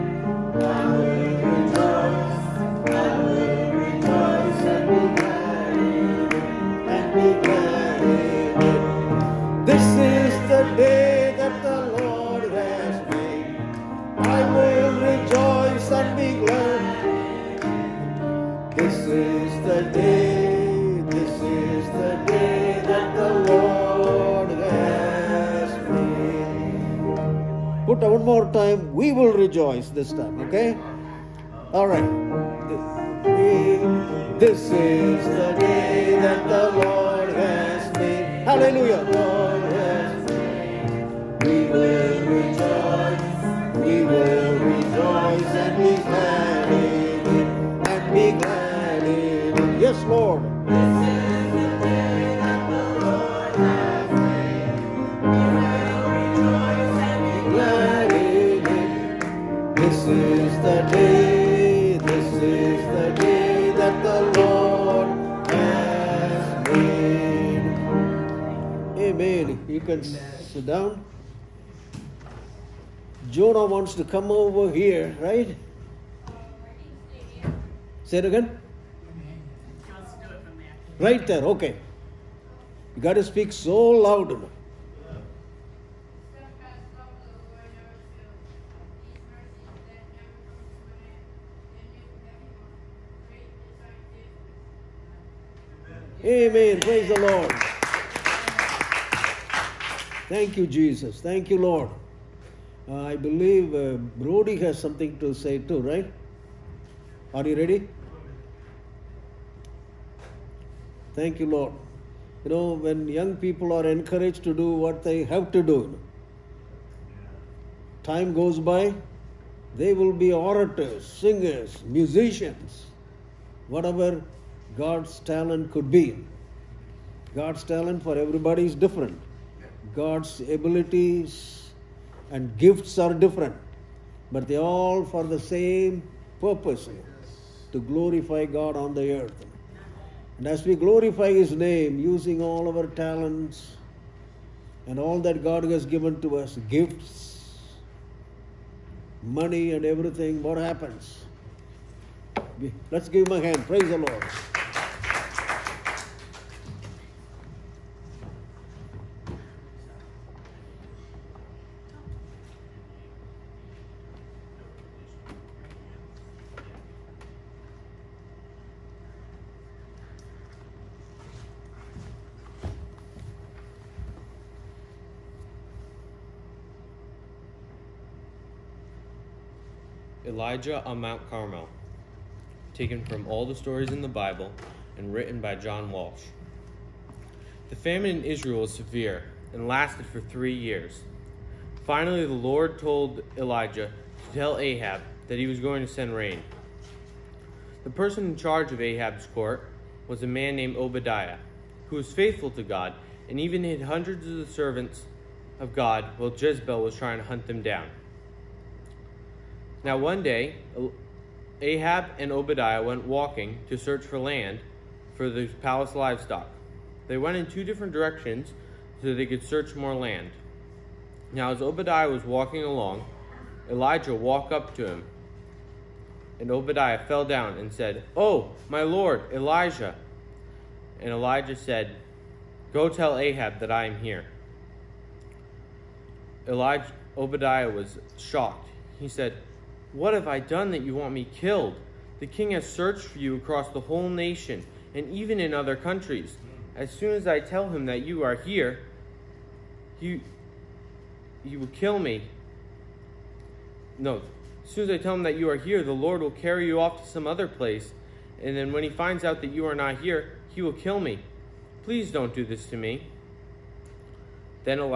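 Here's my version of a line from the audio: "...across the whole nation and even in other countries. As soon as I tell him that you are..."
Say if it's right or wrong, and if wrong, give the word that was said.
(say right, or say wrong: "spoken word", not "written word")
right.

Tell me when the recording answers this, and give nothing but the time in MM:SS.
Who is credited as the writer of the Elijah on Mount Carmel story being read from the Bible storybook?
03:05.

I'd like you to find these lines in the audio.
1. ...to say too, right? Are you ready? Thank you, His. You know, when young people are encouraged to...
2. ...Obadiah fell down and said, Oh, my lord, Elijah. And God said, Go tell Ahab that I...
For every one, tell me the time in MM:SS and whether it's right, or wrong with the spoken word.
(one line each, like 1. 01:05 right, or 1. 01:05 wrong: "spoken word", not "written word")
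1. 01:45 wrong: "Lord", not "His"
2. 03:46 wrong: "Elijah", not "God".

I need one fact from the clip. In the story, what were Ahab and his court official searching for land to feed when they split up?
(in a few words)
palace livestock.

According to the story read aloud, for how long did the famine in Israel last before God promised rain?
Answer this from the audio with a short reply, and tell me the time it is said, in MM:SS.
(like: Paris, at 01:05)
3 years, at 03:10.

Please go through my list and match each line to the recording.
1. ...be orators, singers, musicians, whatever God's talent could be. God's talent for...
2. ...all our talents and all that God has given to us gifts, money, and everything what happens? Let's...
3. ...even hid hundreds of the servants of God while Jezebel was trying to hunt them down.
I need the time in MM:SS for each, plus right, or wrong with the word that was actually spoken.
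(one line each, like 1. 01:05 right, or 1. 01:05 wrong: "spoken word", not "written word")
1. 02:00 right
2. 02:22 right
3. 03:23 right.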